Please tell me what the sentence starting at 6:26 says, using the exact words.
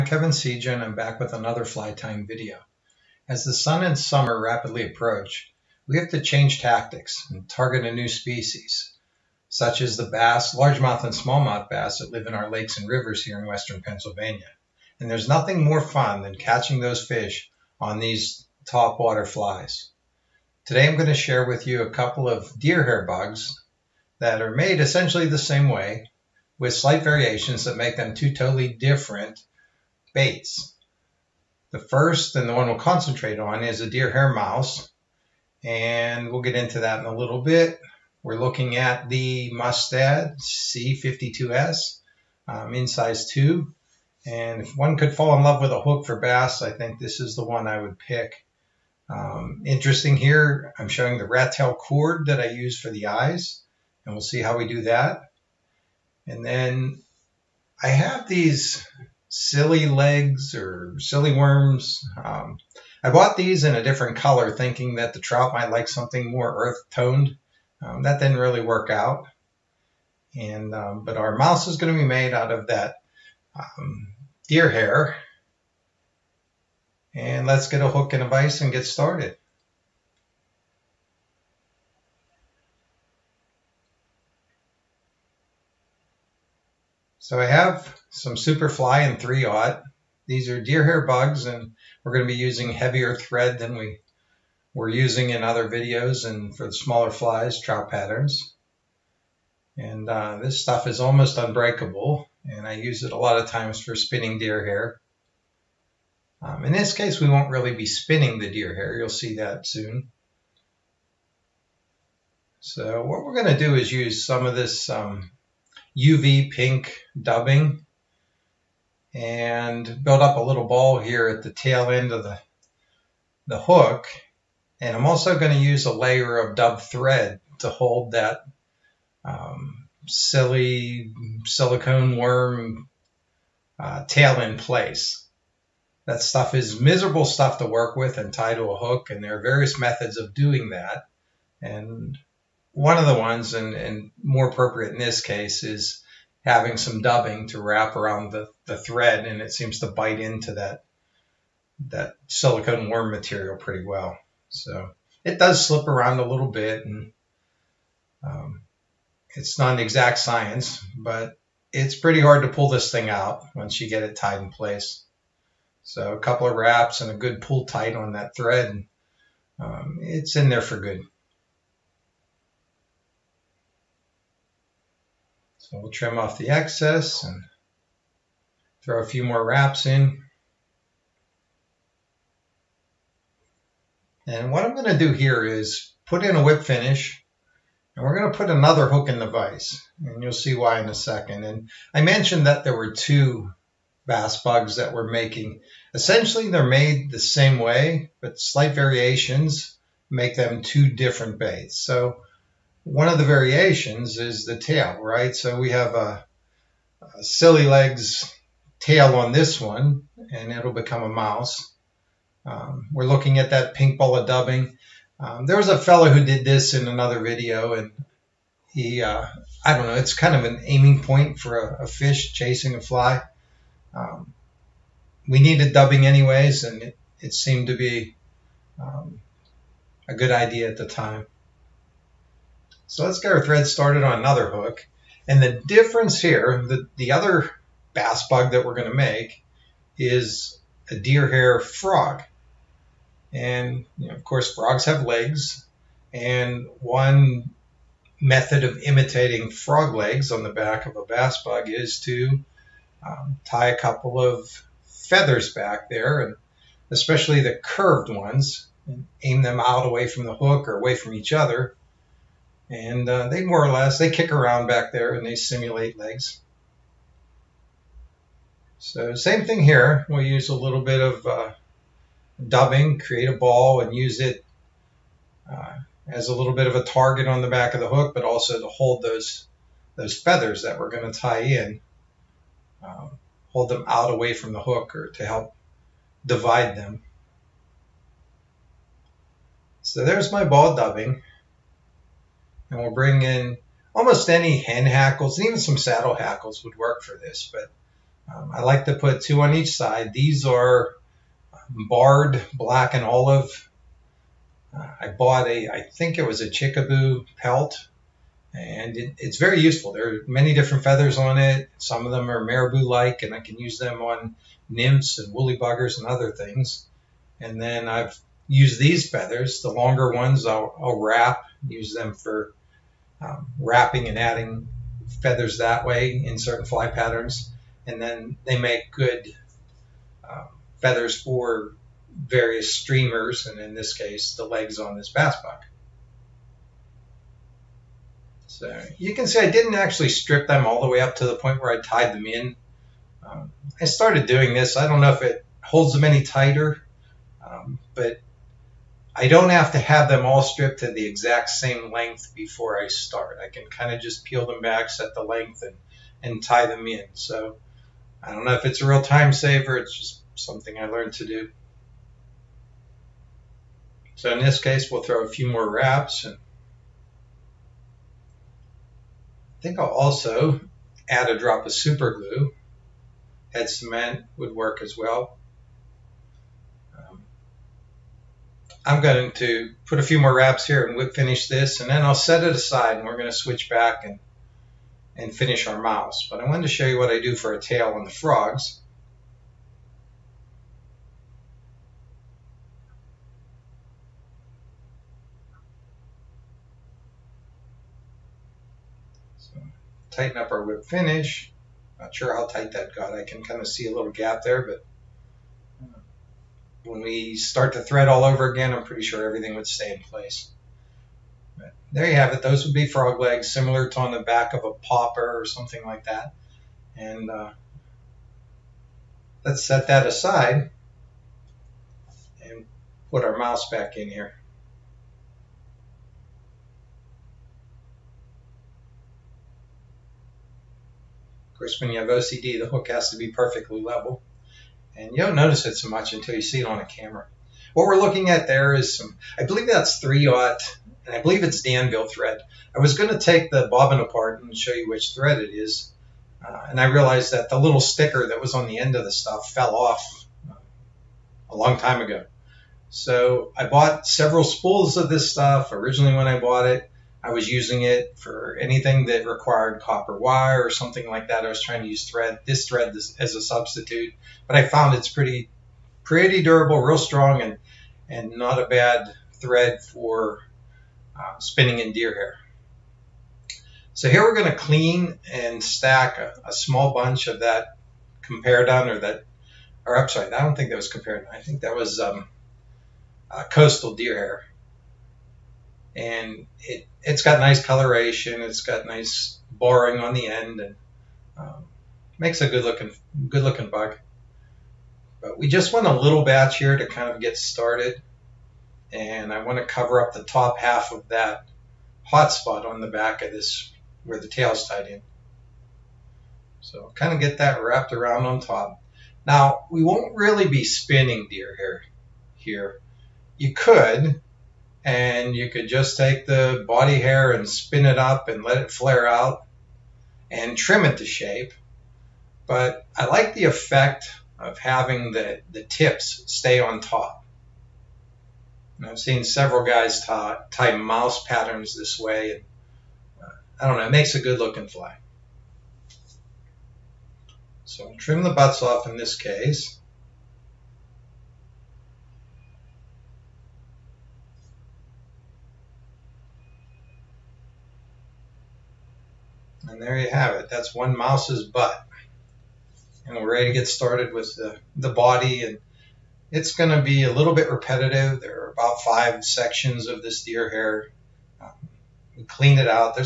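But I wanted to show you what I do for a tail on the frogs.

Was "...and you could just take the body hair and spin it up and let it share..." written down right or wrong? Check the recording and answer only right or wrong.
wrong.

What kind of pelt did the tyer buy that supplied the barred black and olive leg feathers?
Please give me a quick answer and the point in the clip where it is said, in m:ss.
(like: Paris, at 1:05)
Chickabou pelt, at 5:06.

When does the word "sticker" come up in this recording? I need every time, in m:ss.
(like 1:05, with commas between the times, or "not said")
7:27.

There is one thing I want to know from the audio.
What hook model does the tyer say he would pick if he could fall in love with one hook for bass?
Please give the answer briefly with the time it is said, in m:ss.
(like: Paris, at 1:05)
Mustad C52S, at 0:39.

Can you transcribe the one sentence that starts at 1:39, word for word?
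And uh, this stuff is almost unbreakable, and I use it a lot of times for spinning deer hair.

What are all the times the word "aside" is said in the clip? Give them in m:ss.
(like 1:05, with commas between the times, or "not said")
6:22, 7:00.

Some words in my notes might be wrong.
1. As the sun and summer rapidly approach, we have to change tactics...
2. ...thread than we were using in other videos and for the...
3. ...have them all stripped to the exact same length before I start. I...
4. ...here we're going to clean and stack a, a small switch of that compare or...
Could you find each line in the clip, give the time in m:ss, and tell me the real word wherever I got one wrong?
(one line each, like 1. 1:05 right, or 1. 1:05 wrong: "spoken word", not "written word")
1. 0:03 right
2. 1:33 right
3. 5:49 right
4. 7:54 wrong: "bunch", not "switch".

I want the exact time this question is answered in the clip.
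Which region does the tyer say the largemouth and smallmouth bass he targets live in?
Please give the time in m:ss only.
0:13.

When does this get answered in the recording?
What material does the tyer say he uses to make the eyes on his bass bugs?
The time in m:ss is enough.
0:51.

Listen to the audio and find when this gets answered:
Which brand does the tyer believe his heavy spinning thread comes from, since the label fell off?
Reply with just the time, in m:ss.
7:21.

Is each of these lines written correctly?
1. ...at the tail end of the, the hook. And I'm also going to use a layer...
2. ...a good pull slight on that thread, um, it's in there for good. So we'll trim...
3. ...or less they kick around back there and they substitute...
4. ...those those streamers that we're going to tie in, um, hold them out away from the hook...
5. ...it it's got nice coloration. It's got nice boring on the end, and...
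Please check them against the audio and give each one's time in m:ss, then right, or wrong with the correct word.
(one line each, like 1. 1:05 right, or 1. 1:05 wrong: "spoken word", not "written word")
1. 2:01 right
2. 2:47 wrong: "tight", not "slight"
3. 4:23 wrong: "simulate", not "substitute"
4. 4:39 wrong: "feathers", not "streamers"
5. 8:06 right.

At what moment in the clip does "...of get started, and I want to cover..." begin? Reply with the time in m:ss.
8:17.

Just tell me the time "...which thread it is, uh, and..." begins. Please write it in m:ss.
7:24.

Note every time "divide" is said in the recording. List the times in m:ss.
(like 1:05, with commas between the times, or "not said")
4:46.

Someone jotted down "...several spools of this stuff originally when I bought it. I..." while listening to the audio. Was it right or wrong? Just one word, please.
right.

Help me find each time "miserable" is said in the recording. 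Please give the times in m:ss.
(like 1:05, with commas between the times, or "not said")
2:16.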